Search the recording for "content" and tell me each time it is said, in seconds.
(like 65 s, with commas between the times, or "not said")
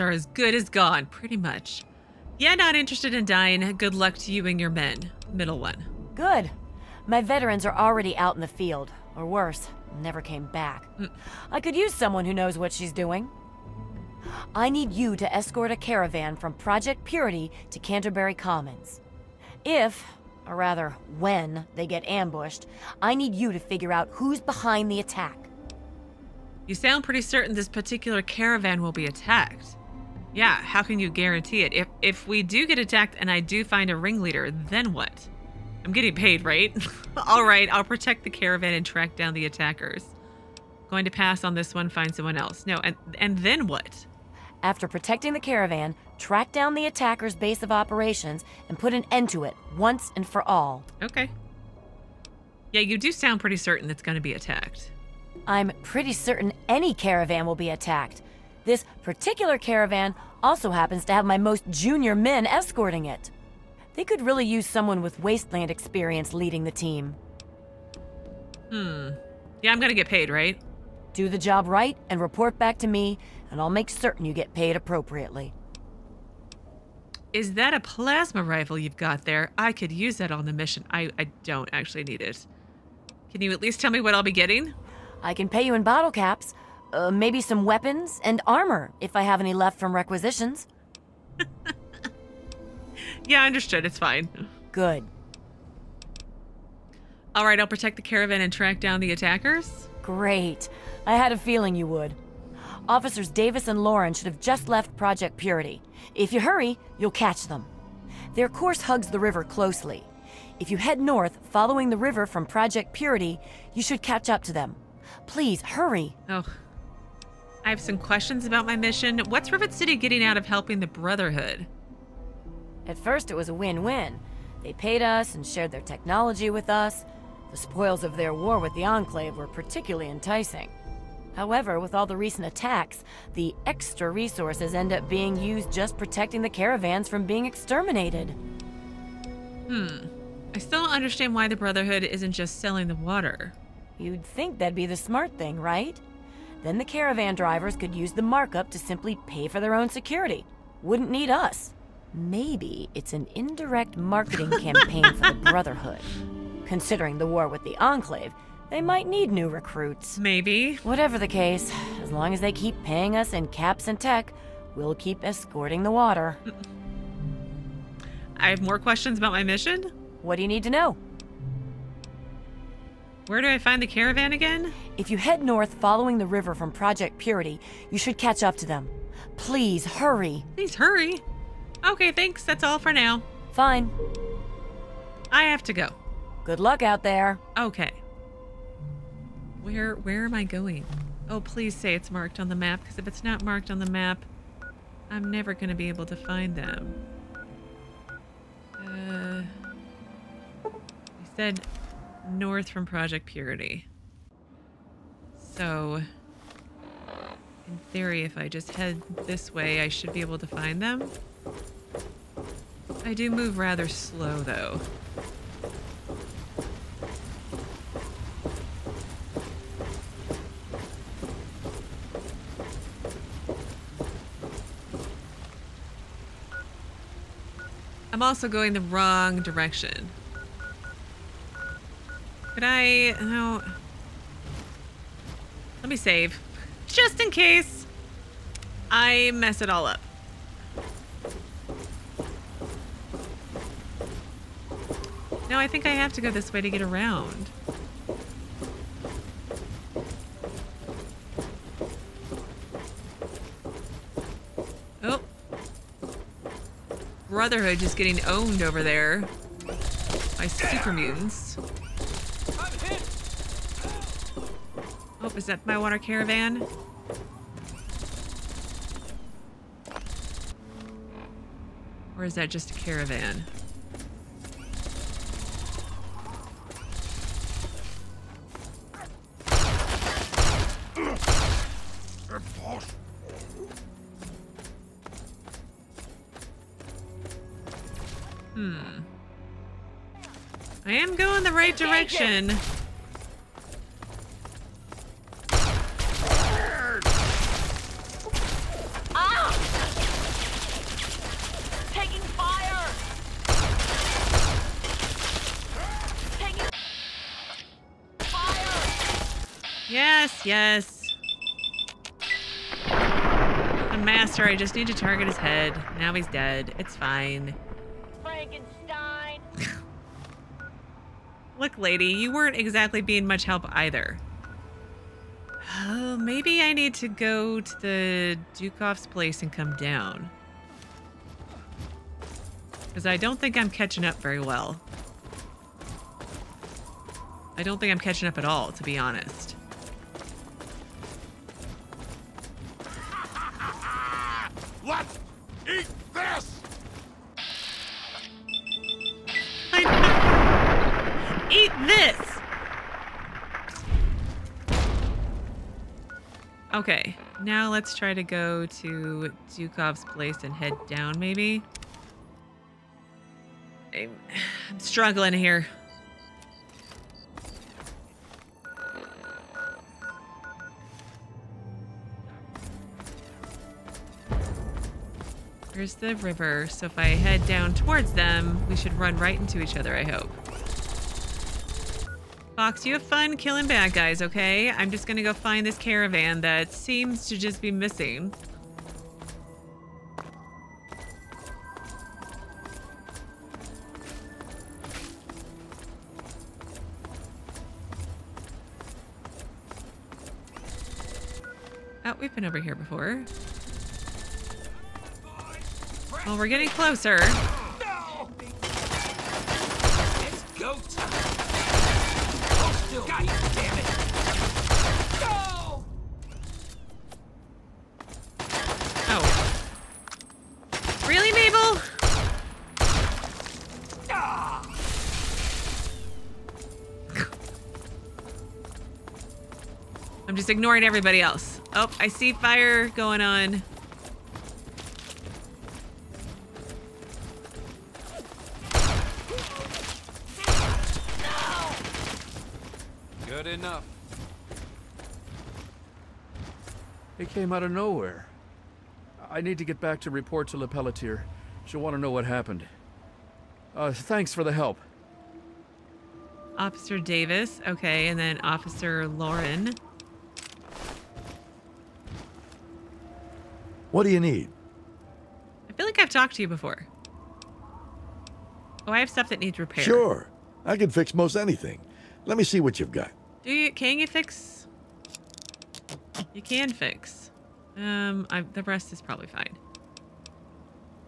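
not said.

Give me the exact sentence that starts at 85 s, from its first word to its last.
I can pay you in bottle caps, uh, maybe some weapons and armor if I have any left from requisitions.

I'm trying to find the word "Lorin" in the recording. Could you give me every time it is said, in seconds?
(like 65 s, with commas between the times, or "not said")
103 s, 459 s.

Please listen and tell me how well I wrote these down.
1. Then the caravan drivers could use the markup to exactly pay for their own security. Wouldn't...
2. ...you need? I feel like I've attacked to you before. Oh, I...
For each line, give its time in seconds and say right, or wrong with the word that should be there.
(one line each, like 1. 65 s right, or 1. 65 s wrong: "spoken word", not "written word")
1. 146 s wrong: "simply", not "exactly"
2. 464 s wrong: "talked", not "attacked".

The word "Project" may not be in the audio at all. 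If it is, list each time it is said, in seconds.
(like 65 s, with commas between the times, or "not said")
16 s, 104 s, 112 s, 176 s, 202 s.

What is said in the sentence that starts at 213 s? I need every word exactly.
I do move rather slow, though.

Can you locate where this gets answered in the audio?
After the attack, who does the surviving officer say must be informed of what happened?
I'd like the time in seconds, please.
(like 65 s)
450 s.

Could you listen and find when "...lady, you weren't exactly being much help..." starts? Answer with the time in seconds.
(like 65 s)
321 s.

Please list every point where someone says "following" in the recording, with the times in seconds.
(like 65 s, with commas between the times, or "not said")
111 s, 175 s.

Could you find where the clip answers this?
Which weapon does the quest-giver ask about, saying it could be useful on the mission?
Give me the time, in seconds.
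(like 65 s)
77 s.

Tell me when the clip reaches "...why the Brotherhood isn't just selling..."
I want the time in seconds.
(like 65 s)
141 s.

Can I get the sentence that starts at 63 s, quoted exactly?
They could really use someone with wasteland experience leading the team.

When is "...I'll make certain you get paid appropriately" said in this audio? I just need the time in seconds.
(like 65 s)
73 s.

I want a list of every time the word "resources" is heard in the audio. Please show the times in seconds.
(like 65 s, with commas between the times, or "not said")
134 s.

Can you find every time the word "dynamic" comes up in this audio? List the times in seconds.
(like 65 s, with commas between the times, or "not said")
not said.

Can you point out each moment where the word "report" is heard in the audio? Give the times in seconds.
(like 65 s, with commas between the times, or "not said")
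72 s, 450 s.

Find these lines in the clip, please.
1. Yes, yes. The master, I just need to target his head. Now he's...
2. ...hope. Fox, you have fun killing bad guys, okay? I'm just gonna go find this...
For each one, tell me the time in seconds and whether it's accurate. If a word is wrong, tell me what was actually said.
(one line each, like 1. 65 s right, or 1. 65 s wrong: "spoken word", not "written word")
1. 309 s right
2. 380 s right.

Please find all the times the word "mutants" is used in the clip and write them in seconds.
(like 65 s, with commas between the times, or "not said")
260 s.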